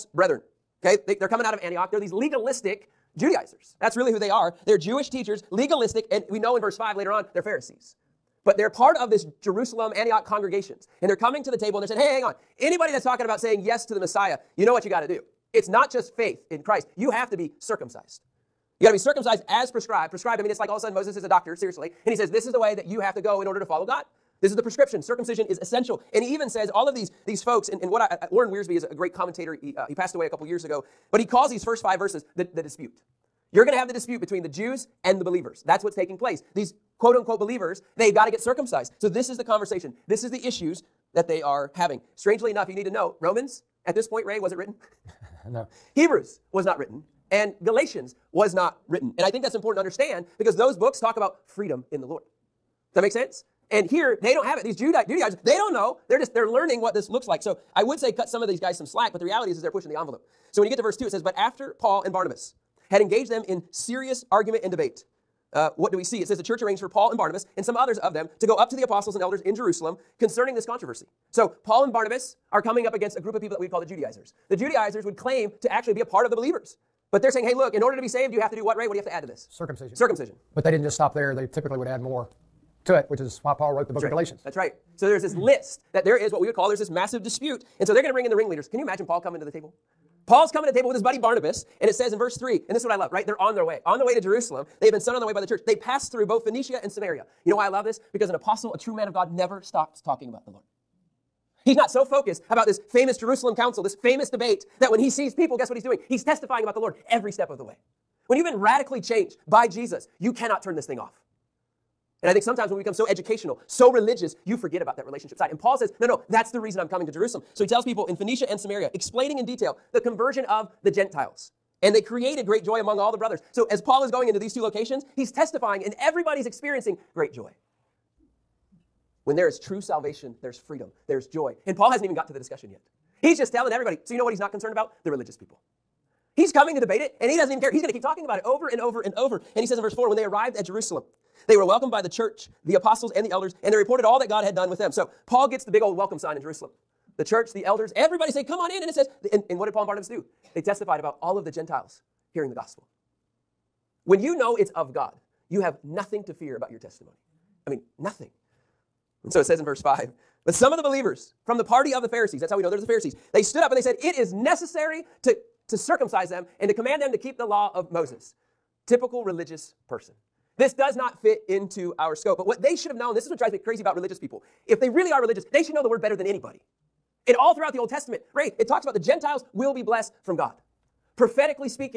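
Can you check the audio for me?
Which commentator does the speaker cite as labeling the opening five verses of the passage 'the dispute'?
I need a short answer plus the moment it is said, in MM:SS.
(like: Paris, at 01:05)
Warren Wiersbe, at 00:28.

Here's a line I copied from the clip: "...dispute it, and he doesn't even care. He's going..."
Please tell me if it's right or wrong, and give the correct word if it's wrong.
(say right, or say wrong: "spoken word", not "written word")
wrong: "debate", not "dispute".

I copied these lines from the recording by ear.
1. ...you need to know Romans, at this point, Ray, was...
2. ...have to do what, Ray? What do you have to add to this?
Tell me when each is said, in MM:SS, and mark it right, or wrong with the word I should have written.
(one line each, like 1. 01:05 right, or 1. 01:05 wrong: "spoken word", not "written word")
1. 00:42 right
2. 01:18 right.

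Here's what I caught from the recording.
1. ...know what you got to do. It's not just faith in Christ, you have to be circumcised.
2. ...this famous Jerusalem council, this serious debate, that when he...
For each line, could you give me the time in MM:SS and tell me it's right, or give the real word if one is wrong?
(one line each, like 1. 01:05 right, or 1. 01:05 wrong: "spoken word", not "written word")
1. 00:14 right
2. 01:42 wrong: "famous", not "serious".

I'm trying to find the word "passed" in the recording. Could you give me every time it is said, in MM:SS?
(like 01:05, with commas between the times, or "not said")
00:29, 01:35.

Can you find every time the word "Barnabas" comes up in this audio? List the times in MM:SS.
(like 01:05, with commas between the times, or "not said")
01:02, 01:07, 01:11, 01:31, 02:29.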